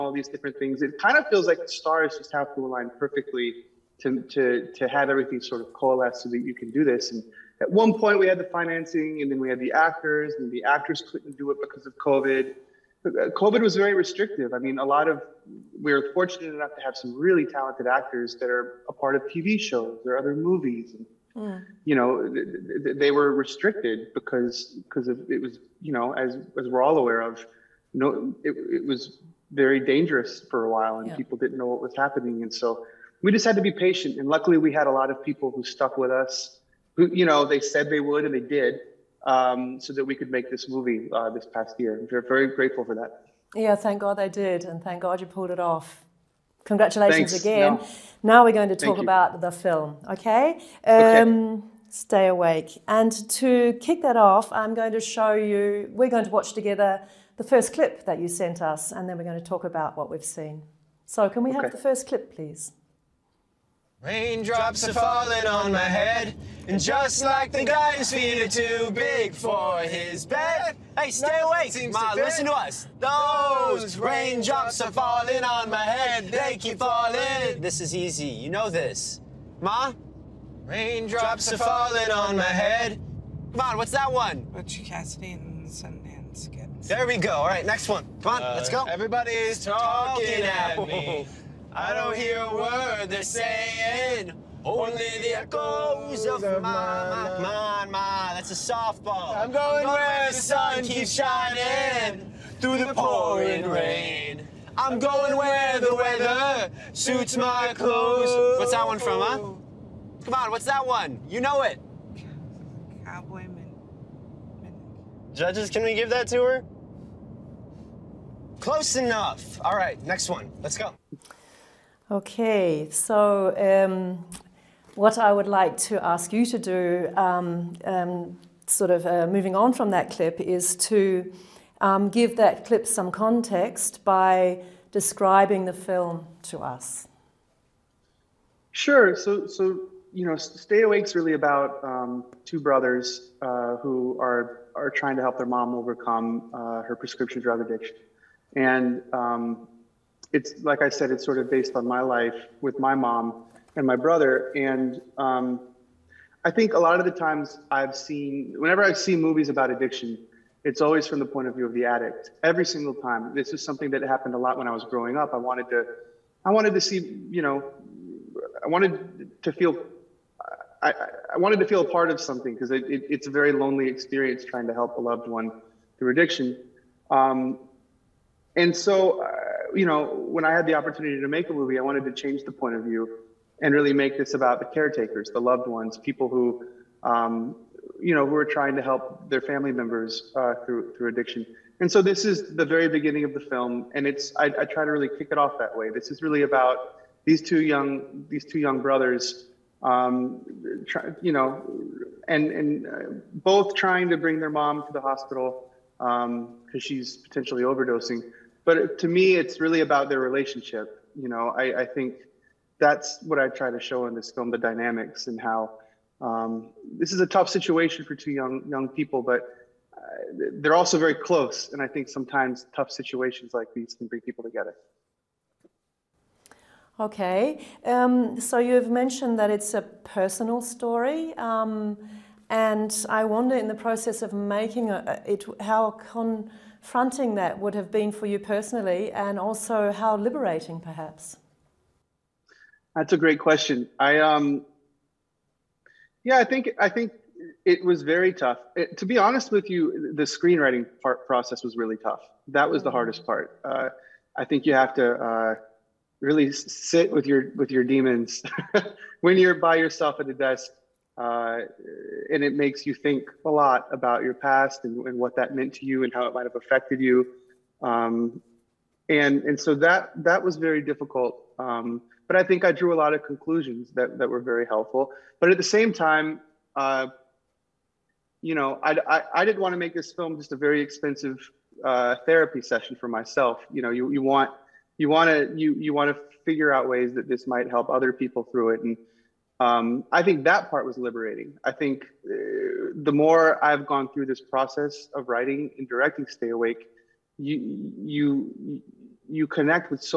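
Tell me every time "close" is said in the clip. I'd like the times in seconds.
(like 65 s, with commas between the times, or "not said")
118 s, 221 s.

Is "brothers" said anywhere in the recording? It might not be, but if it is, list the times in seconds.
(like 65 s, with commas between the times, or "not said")
142 s, 153 s, 198 s.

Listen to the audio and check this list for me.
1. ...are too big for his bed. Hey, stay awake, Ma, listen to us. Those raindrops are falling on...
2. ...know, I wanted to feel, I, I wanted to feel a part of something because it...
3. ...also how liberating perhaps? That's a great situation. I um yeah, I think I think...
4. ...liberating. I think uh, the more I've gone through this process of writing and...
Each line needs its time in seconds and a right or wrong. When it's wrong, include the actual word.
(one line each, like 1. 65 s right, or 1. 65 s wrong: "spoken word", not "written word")
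1. 68 s right
2. 167 s right
3. 239 s wrong: "question", not "situation"
4. 290 s right.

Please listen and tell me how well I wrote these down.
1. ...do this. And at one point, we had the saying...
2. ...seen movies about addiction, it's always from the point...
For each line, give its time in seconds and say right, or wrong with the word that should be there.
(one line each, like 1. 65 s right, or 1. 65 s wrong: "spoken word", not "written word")
1. 6 s wrong: "financing", not "saying"
2. 158 s right.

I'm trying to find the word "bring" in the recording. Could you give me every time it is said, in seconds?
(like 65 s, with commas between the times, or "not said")
204 s, 224 s.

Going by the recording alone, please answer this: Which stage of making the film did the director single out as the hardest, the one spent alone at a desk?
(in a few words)
screenwriting.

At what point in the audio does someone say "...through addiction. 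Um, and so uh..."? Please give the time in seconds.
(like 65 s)
175 s.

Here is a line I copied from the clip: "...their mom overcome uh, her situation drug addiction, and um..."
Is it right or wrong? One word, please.
wrong.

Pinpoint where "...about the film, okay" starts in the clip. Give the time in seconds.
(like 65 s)
48 s.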